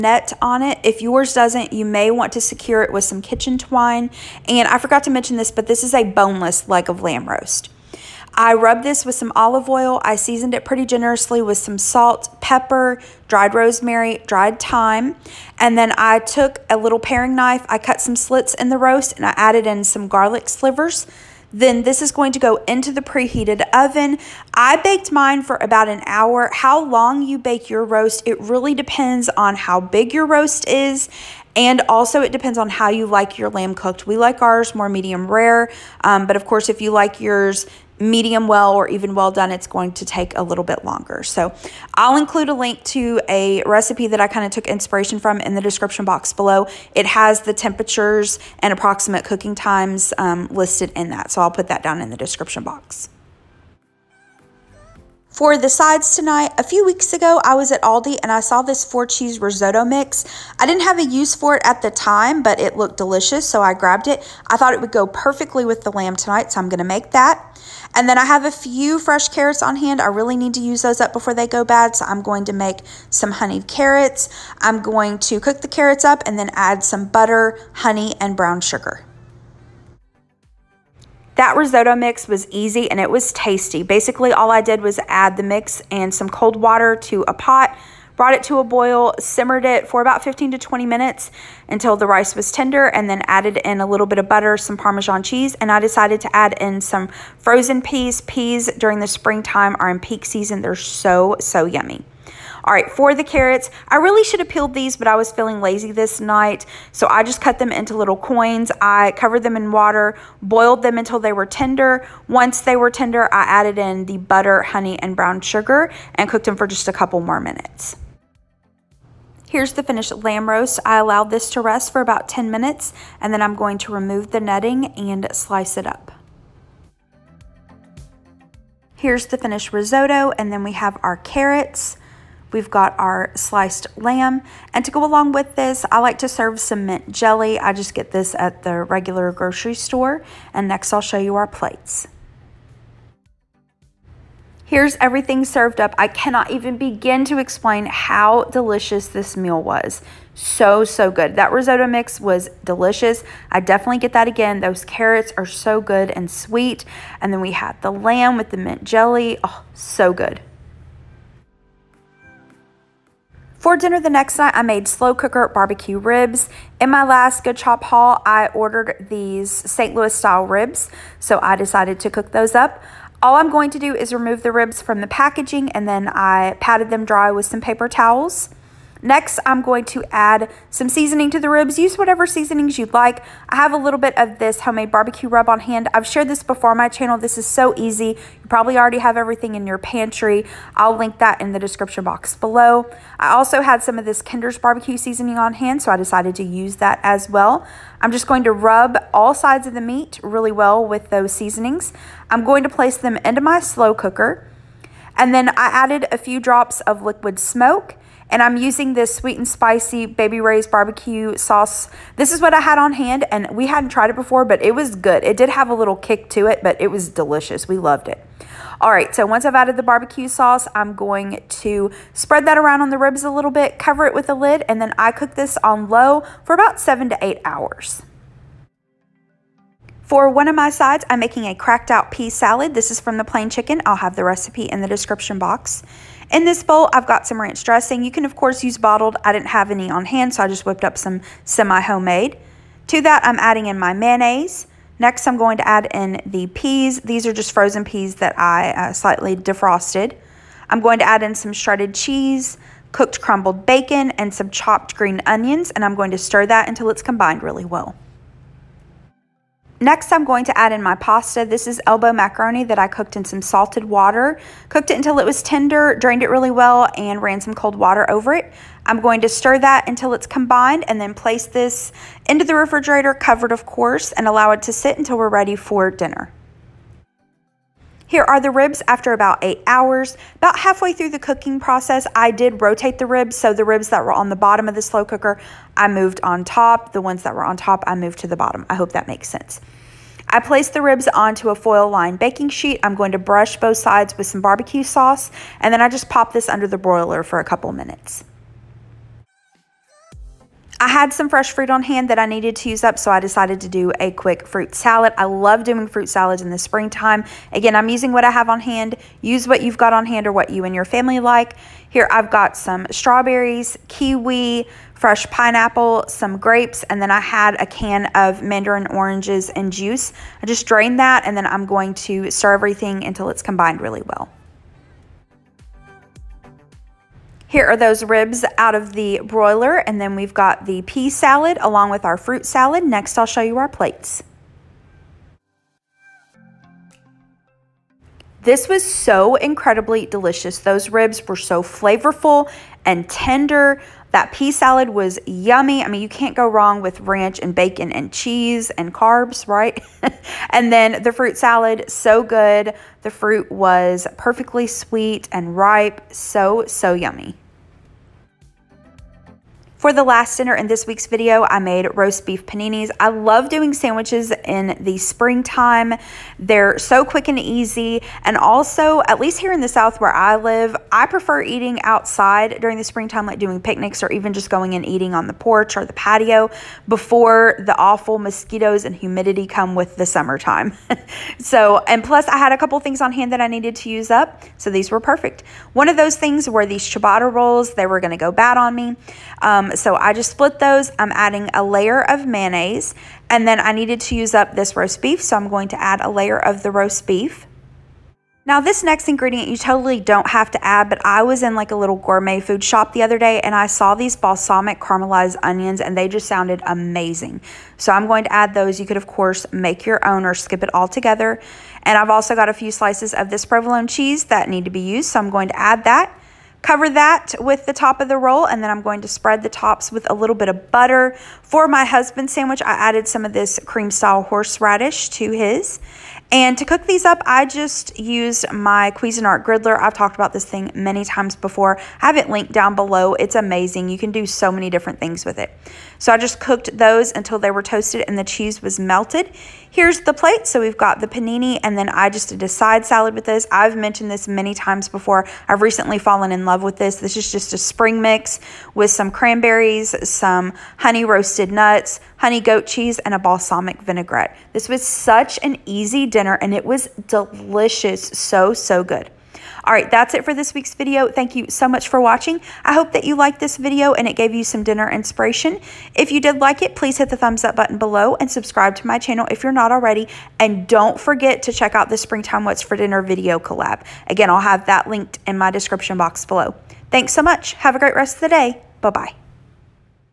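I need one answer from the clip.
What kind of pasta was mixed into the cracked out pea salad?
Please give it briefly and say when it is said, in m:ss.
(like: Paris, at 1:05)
elbow macaroni, at 4:21.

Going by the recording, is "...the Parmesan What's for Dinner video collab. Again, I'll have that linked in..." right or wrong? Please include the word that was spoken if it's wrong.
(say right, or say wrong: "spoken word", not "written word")
wrong: "Springtime", not "Parmesan".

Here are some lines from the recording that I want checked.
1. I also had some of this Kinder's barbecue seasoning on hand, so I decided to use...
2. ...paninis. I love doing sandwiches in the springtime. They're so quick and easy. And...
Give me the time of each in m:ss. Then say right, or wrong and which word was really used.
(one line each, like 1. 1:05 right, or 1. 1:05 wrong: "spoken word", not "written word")
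1. 3:13 right
2. 6:02 right.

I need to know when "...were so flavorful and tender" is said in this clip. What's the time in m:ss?
5:41.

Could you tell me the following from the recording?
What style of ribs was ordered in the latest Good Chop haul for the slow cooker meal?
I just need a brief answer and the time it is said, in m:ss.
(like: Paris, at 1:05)
St. Louis style, at 2:49.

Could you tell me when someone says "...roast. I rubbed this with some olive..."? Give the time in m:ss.
0:07.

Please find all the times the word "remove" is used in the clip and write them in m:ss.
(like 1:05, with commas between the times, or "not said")
2:03, 2:54.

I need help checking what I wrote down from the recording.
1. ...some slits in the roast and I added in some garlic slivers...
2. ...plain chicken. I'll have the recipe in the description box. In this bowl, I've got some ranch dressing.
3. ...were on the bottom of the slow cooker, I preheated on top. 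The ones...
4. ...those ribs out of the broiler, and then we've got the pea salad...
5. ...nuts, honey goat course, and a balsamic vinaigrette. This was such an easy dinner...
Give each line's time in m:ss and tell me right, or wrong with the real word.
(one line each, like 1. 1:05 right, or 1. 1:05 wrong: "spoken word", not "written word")
1. 0:18 right
2. 3:53 right
3. 4:44 wrong: "moved", not "preheated"
4. 5:27 right
5. 7:31 wrong: "cheese", not "course".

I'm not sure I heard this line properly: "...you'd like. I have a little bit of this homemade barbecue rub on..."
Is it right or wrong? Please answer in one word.
right.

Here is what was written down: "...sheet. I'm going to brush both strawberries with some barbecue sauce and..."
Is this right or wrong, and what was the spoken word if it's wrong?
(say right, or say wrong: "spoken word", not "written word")
wrong: "sides", not "strawberries".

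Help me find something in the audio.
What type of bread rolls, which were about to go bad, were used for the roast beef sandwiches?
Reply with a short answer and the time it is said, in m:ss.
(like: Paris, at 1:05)
ciabatta rolls, at 6:26.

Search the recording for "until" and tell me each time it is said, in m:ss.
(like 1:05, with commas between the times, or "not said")
1:31, 1:50, 4:16, 4:24, 4:29, 4:34, 5:23, 7:17.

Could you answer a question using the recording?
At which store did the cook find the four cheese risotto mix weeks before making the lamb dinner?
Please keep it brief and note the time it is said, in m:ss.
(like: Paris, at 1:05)
Aldi, at 0:57.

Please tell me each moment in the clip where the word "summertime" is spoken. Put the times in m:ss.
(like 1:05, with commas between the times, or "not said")
6:20.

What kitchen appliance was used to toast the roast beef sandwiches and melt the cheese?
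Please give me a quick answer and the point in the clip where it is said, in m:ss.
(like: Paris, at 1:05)
Cuisinart griddler, at 7:08.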